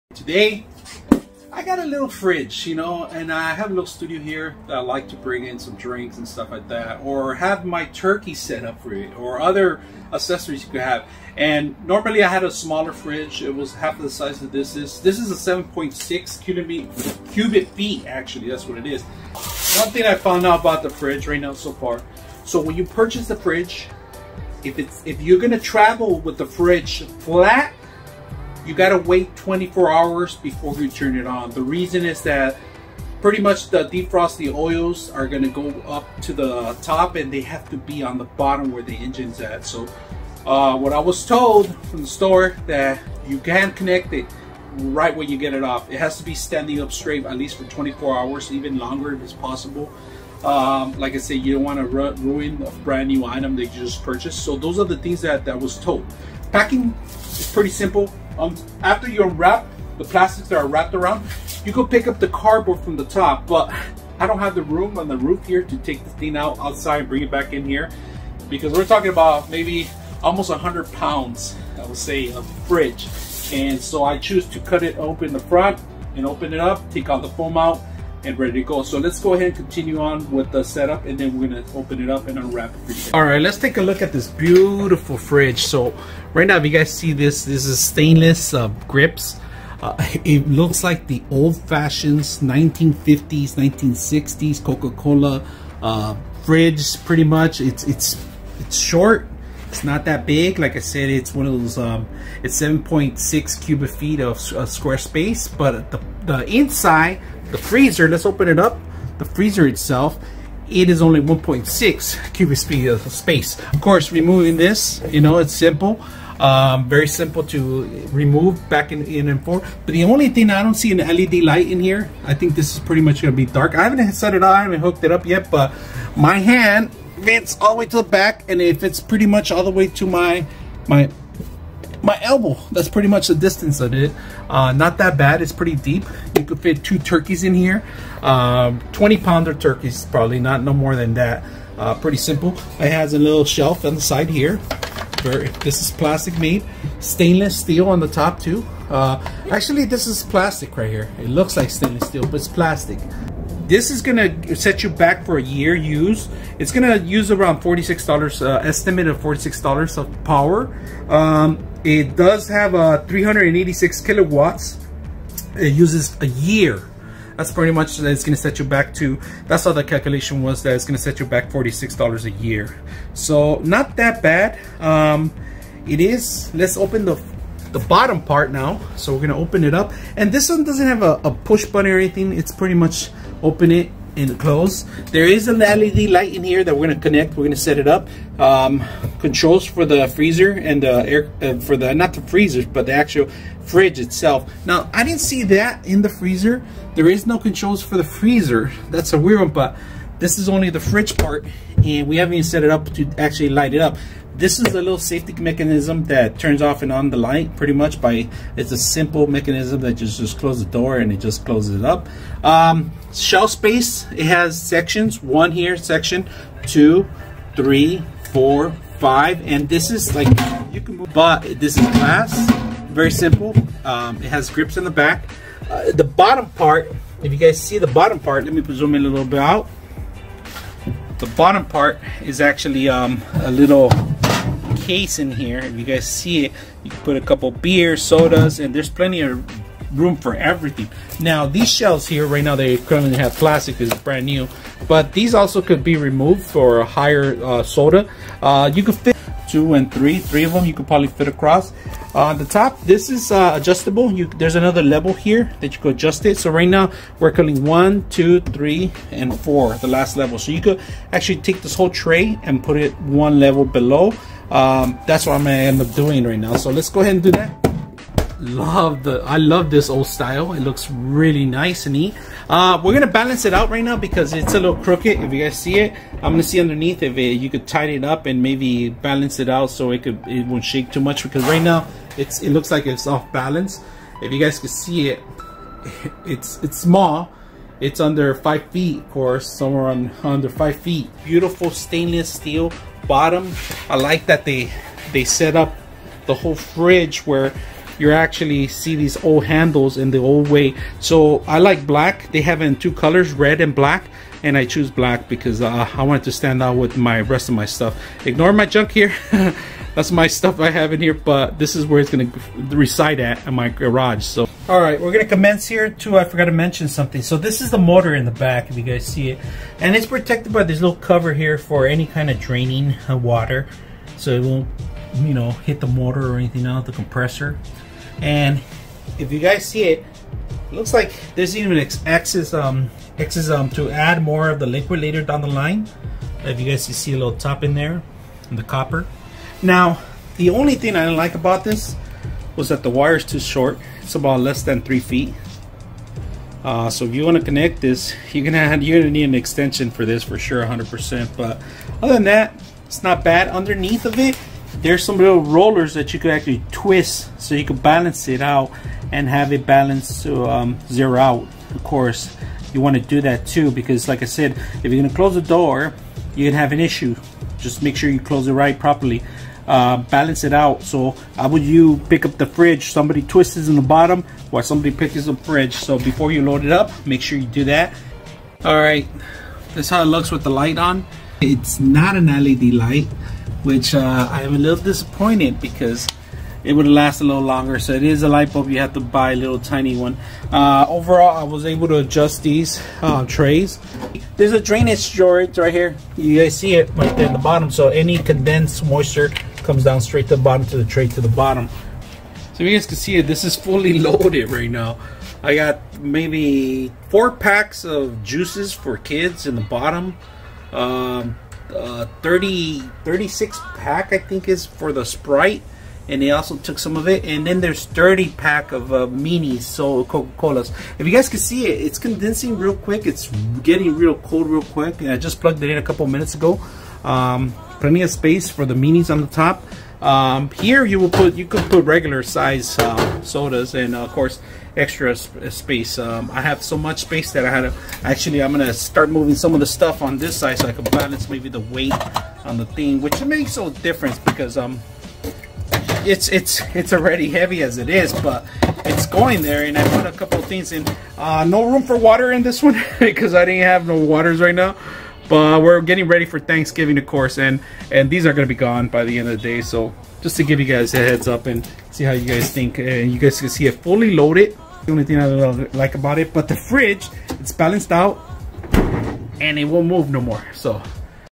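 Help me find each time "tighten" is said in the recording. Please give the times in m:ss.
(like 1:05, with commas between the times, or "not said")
4:37.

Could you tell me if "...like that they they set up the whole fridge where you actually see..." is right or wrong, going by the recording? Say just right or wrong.
right.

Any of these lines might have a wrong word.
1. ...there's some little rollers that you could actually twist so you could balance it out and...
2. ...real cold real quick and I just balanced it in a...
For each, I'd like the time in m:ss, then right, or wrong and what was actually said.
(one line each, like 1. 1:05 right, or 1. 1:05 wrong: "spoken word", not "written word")
1. 5:54 right
2. 7:03 wrong: "plugged", not "balanced".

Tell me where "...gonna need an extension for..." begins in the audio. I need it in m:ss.
5:48.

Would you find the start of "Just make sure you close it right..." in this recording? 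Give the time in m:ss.
6:07.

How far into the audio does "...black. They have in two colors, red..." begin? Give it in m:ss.
5:01.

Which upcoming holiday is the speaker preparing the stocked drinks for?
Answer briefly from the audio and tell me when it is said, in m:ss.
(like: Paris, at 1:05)
Thanksgiving, at 7:36.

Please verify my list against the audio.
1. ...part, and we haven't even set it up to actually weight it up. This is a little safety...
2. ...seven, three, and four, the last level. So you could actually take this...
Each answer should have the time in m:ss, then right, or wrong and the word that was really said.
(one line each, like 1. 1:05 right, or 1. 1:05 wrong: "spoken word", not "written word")
1. 3:21 wrong: "light", not "weight"
2. 4:18 wrong: "two", not "seven".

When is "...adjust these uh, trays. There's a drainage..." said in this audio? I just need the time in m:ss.
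6:31.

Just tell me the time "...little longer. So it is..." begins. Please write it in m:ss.
6:27.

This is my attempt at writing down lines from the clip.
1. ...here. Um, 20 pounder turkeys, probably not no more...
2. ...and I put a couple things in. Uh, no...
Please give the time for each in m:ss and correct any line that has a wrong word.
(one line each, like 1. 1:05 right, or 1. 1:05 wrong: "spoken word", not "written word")
1. 2:17 right
2. 7:29 right.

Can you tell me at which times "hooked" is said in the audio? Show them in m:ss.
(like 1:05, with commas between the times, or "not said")
2:04.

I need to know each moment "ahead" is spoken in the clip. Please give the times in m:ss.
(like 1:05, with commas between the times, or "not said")
1:19, 4:26.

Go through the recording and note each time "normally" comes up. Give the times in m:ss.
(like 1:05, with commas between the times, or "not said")
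0:11.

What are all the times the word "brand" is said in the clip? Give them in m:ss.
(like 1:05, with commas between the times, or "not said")
0:52, 4:04.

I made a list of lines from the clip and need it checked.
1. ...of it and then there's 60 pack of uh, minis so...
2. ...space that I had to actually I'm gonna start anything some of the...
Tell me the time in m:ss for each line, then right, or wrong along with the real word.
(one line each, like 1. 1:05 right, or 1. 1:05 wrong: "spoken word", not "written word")
1. 6:56 wrong: "30", not "60"
2. 7:17 wrong: "moving", not "anything".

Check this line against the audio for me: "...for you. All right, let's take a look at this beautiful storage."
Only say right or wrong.
wrong.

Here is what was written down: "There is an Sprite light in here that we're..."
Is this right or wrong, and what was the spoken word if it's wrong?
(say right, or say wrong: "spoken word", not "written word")
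wrong: "LED", not "Sprite".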